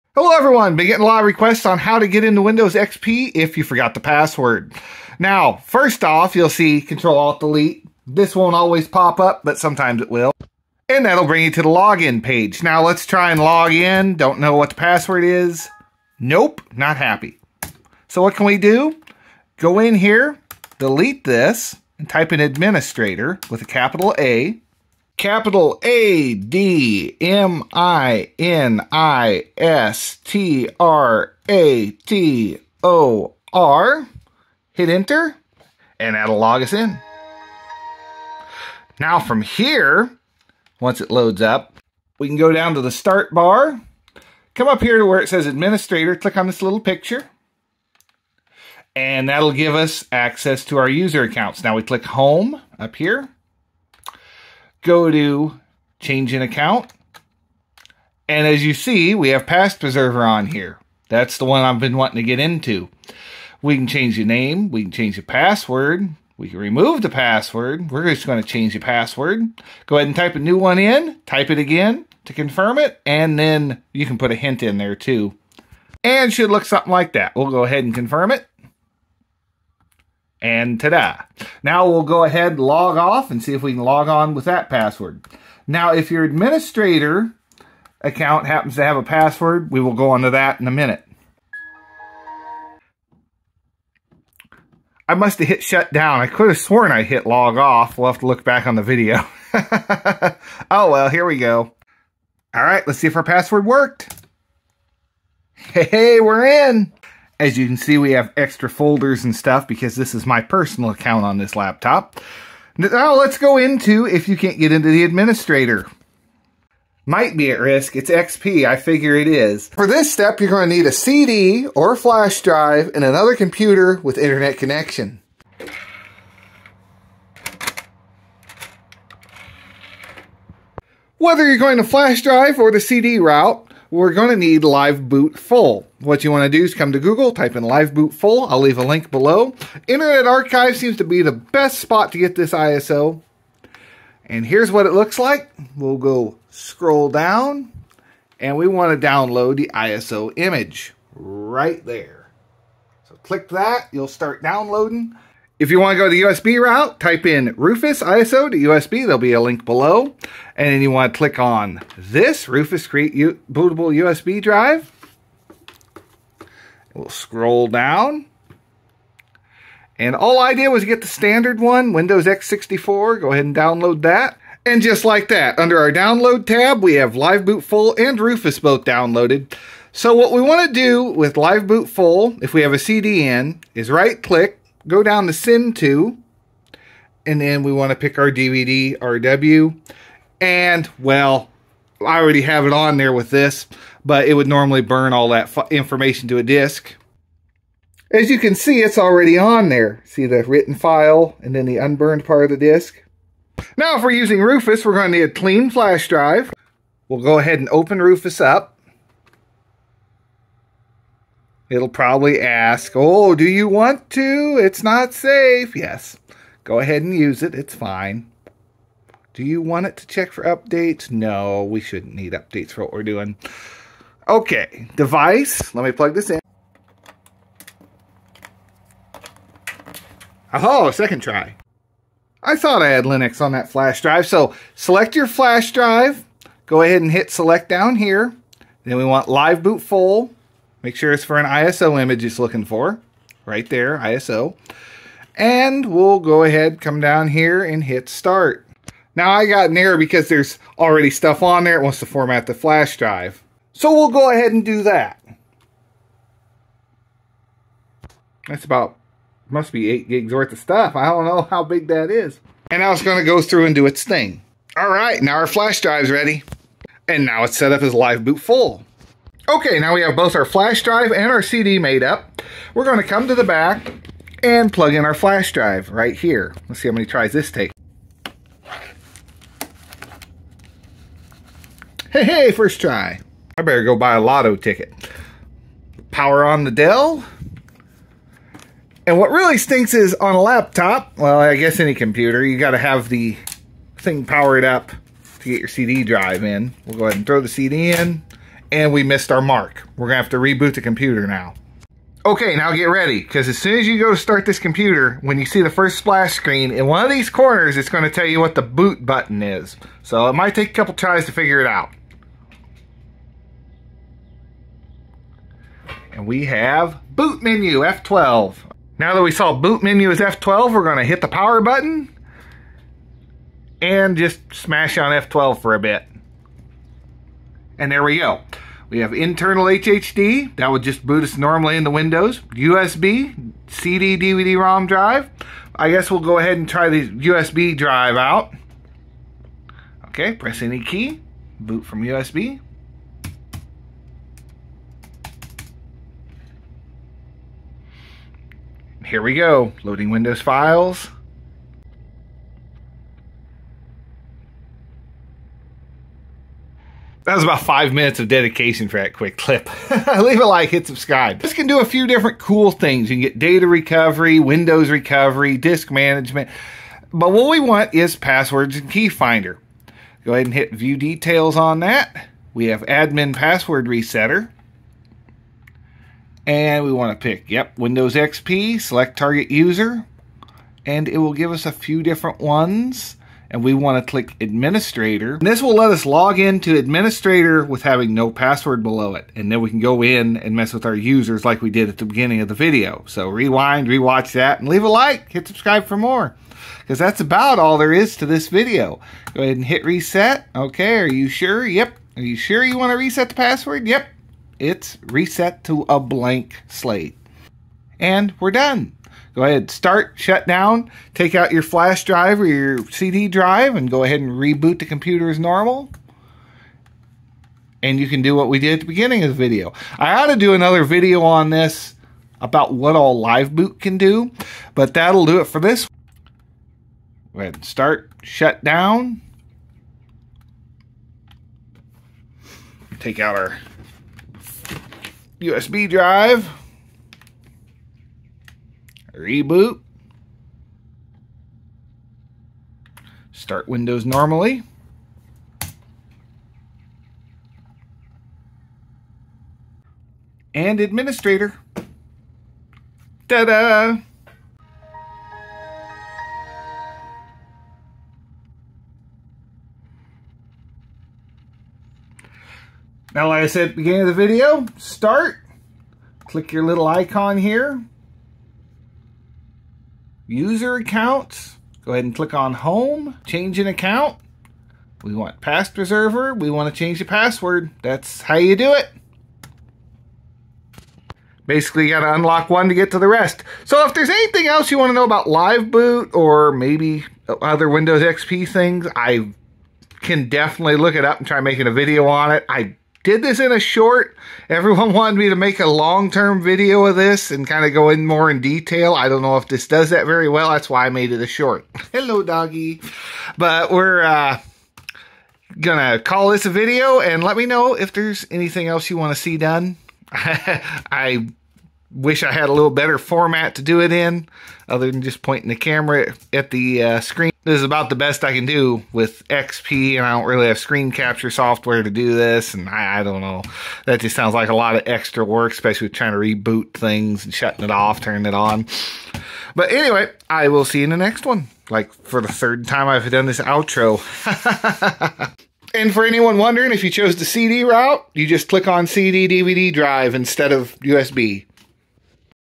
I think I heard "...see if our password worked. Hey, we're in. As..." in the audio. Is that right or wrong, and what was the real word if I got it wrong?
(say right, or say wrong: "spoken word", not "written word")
right.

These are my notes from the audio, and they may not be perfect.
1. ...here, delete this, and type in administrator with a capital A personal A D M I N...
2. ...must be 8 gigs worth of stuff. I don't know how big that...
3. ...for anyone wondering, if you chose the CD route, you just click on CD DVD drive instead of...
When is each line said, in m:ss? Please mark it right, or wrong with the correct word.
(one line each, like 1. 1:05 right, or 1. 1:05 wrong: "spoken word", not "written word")
1. 0:19 wrong: "capital", not "personal"
2. 4:19 right
3. 8:55 right.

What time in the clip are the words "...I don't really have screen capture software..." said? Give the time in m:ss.
8:40.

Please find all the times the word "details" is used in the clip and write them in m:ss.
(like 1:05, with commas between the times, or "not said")
6:10, 8:18.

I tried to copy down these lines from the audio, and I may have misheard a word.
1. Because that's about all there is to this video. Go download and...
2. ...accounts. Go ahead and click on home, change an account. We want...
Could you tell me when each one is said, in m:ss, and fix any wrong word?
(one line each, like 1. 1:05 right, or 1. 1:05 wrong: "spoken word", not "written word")
1. 6:36 wrong: "ahead", not "download"
2. 7:50 right.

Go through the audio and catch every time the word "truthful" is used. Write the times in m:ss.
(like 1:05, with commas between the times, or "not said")
not said.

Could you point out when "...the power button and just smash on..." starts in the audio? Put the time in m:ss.
5:21.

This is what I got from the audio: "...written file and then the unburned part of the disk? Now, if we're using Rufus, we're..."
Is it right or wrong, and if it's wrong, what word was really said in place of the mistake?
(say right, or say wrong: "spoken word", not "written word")
right.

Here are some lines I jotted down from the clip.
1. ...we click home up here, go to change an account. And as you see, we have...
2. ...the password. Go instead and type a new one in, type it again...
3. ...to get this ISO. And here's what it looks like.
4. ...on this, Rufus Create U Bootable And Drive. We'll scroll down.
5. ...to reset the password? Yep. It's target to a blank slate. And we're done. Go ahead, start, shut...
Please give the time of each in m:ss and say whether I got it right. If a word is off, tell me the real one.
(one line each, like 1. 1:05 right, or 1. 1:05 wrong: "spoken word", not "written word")
1. 0:51 right
2. 1:08 wrong: "ahead", not "instead"
3. 2:22 right
4. 2:41 wrong: "USB", not "And"
5. 6:42 wrong: "reset", not "target".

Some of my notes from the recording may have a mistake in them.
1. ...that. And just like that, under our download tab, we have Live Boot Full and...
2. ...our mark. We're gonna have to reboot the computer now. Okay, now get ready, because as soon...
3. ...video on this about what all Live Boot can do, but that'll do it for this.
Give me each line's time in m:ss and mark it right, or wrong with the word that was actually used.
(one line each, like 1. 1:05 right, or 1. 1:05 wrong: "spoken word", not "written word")
1. 2:54 right
2. 4:59 right
3. 7:00 right.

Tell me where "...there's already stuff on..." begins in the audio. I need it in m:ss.
4:10.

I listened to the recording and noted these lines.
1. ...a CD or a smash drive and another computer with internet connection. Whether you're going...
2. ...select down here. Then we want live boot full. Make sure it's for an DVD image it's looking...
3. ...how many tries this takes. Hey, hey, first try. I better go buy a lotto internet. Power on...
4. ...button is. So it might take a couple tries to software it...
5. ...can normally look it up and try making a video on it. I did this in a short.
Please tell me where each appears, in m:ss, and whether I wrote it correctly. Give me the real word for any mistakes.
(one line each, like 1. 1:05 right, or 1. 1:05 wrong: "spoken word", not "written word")
1. 2:00 wrong: "flash", not "smash"
2. 3:57 wrong: "ISO", not "DVD"
3. 4:36 wrong: "ticket", not "internet"
4. 5:09 wrong: "figure", not "software"
5. 8:10 wrong: "definitely", not "normally".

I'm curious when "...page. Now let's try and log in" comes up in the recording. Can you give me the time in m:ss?
0:12.